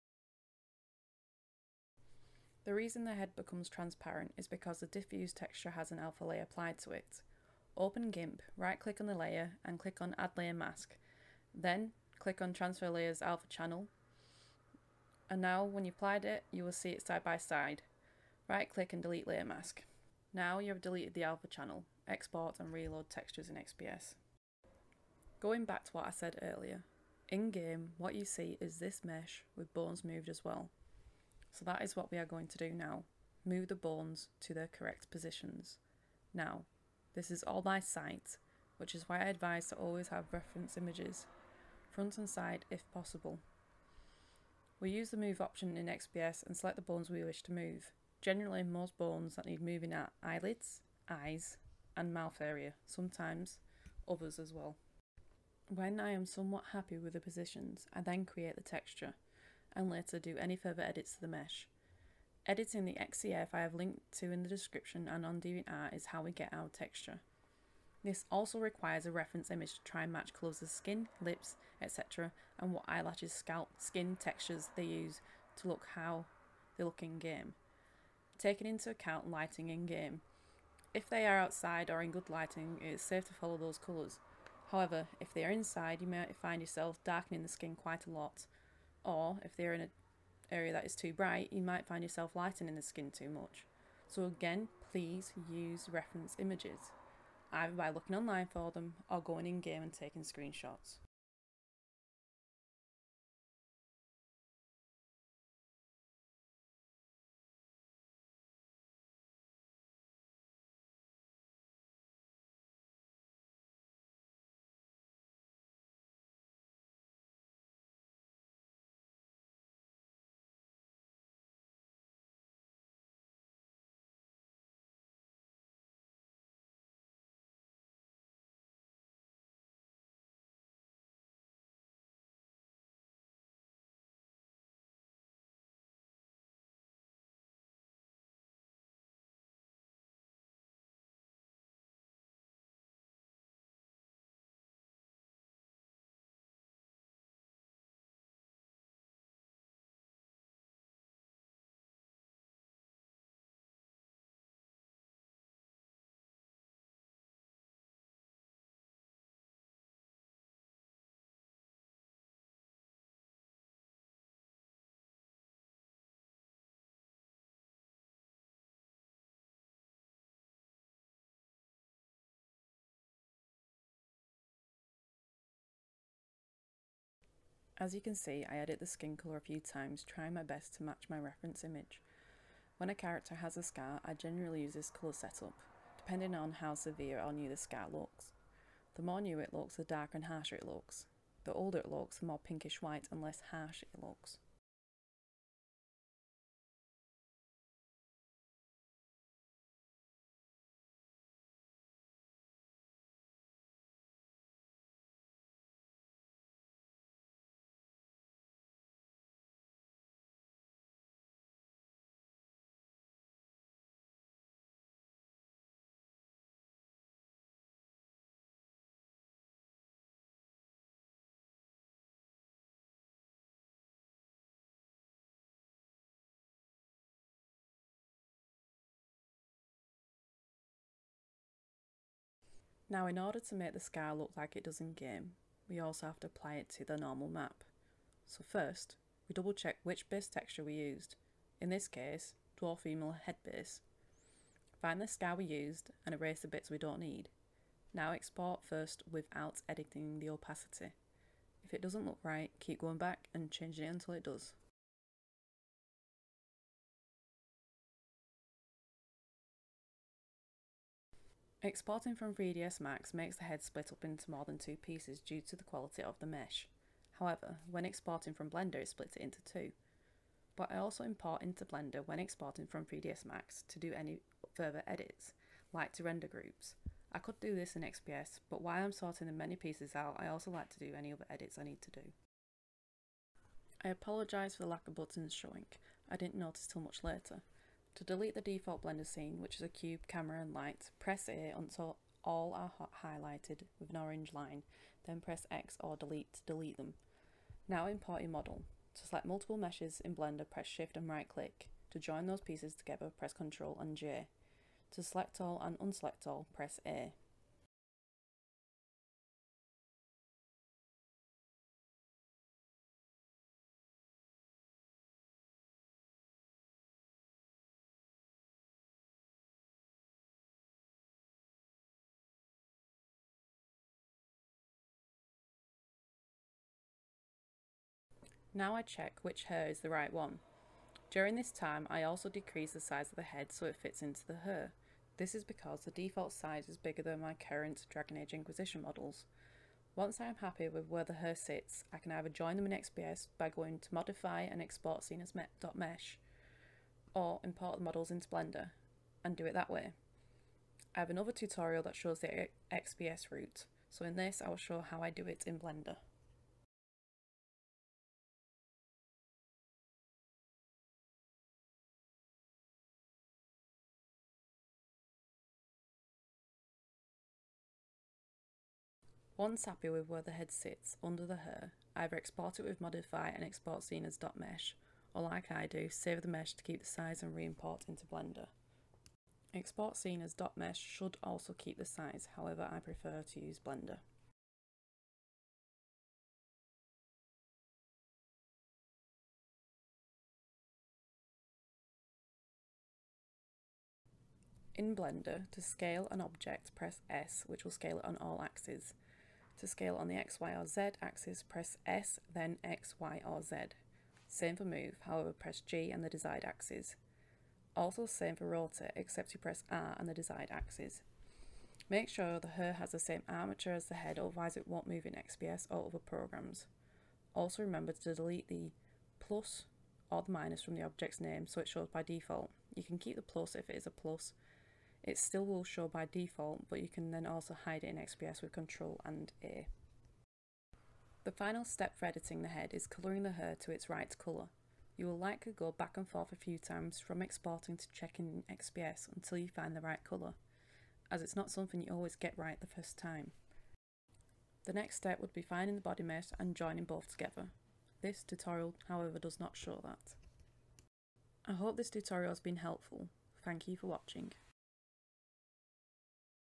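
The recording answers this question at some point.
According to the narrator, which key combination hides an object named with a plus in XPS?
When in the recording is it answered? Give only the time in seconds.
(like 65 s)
428 s.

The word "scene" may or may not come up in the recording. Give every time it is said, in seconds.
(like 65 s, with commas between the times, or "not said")
289 s, 345 s, 373 s, 379 s.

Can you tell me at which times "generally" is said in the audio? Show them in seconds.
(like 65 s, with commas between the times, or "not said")
48 s, 184 s.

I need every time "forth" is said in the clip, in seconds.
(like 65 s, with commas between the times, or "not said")
436 s.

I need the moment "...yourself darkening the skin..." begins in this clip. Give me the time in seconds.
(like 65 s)
86 s.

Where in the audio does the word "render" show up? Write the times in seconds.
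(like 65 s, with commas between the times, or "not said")
276 s.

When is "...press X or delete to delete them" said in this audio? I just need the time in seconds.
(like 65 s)
295 s.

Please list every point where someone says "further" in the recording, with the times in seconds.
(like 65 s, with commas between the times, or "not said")
60 s, 274 s.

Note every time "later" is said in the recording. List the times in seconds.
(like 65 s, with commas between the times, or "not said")
59 s, 287 s.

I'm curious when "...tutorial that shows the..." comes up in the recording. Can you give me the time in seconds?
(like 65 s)
351 s.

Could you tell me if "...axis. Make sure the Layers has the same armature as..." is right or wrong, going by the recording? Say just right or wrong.
wrong.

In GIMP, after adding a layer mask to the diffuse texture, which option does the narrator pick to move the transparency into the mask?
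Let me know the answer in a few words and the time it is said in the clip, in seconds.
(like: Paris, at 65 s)
Transfer Layers Alpha Channel, at 12 s.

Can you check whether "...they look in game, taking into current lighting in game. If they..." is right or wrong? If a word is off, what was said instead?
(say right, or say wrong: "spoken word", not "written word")
wrong: "account", not "current".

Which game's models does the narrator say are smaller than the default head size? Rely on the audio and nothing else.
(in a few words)
Dragon Age Inquisition.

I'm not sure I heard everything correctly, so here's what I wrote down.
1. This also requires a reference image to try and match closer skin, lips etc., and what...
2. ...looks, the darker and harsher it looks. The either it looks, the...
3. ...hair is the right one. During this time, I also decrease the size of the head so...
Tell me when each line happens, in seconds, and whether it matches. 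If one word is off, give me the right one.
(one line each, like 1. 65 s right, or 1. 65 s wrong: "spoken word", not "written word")
1. 68 s right
2. 189 s wrong: "older", not "either"
3. 329 s right.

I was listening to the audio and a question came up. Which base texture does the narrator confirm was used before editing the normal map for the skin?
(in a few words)
Dwarf Female Head Base.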